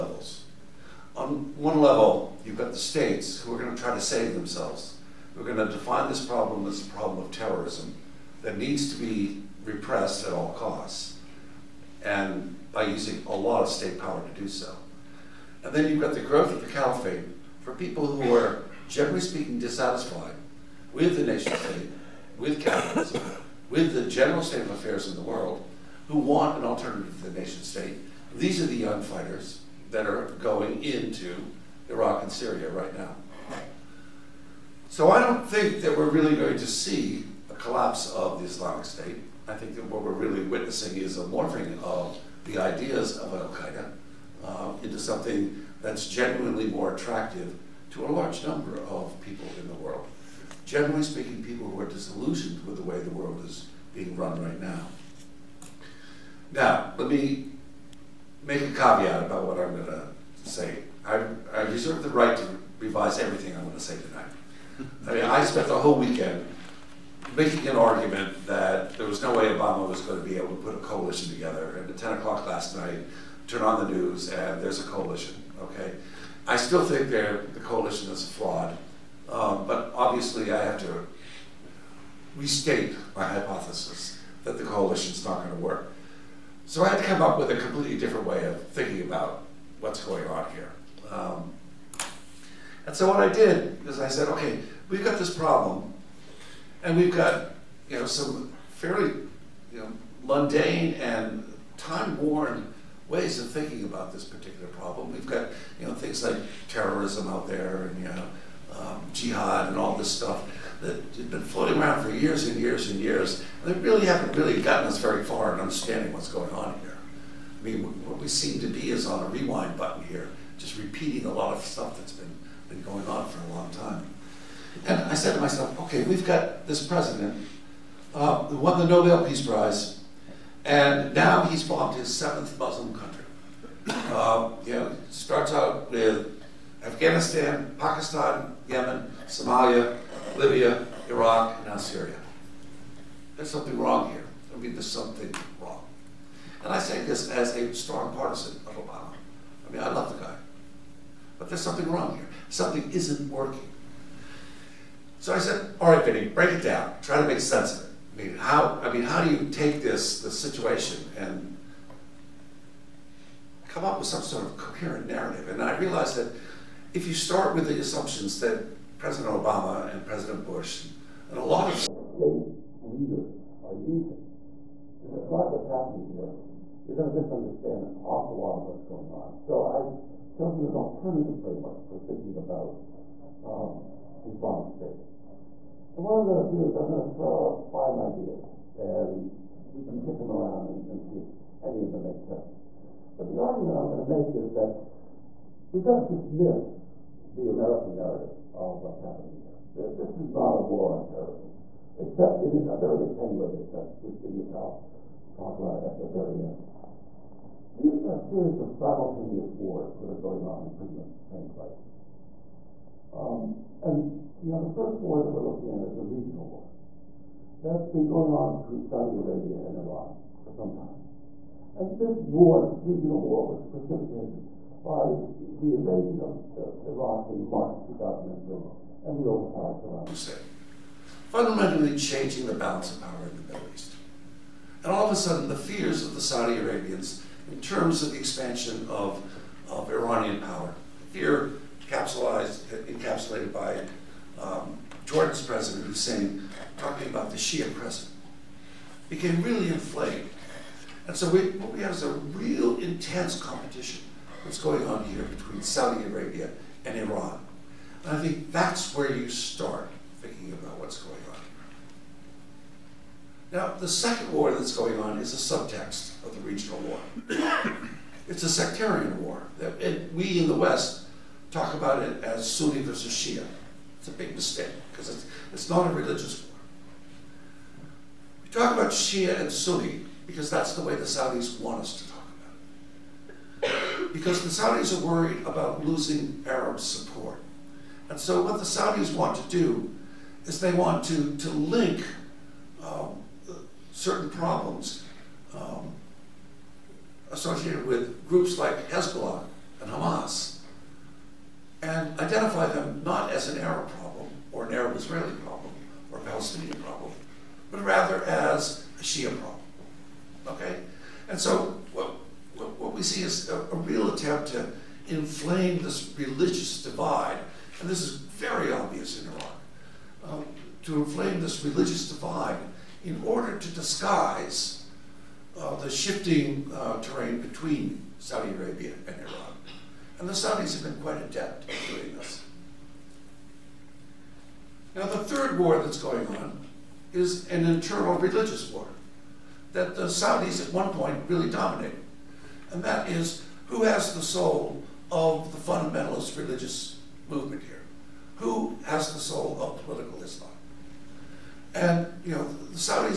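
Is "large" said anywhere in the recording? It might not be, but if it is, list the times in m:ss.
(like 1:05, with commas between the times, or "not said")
0:48.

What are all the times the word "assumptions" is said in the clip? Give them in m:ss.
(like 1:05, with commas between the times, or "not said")
2:47.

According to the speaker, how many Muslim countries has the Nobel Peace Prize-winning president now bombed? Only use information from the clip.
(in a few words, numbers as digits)
7.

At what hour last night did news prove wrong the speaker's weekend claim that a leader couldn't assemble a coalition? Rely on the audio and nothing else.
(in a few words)
10 o'clock.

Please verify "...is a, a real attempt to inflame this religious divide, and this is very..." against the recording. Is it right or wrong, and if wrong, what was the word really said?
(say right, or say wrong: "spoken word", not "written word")
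right.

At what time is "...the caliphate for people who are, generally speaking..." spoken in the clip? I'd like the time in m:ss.
0:16.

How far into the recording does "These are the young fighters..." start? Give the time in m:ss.
0:28.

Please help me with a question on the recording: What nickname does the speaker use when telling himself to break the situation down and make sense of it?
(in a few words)
Vinny.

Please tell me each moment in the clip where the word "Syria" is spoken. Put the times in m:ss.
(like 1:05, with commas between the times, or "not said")
0:32, 2:21.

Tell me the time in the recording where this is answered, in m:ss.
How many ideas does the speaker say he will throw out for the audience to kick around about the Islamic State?
3:07.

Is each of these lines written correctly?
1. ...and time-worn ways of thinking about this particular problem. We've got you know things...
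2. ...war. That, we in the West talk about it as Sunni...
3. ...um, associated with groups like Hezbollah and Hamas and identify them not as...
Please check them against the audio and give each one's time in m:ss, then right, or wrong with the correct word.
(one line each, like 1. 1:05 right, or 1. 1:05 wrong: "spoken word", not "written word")
1. 1:40 right
2. 4:29 right
3. 4:55 right.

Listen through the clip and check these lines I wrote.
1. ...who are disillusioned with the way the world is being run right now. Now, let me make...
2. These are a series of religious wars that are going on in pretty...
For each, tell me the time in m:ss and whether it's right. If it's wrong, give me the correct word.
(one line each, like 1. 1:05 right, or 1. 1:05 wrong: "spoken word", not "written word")
1. 0:51 right
2. 3:27 wrong: "simultaneous", not "religious".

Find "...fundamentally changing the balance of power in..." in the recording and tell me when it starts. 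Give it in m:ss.
3:51.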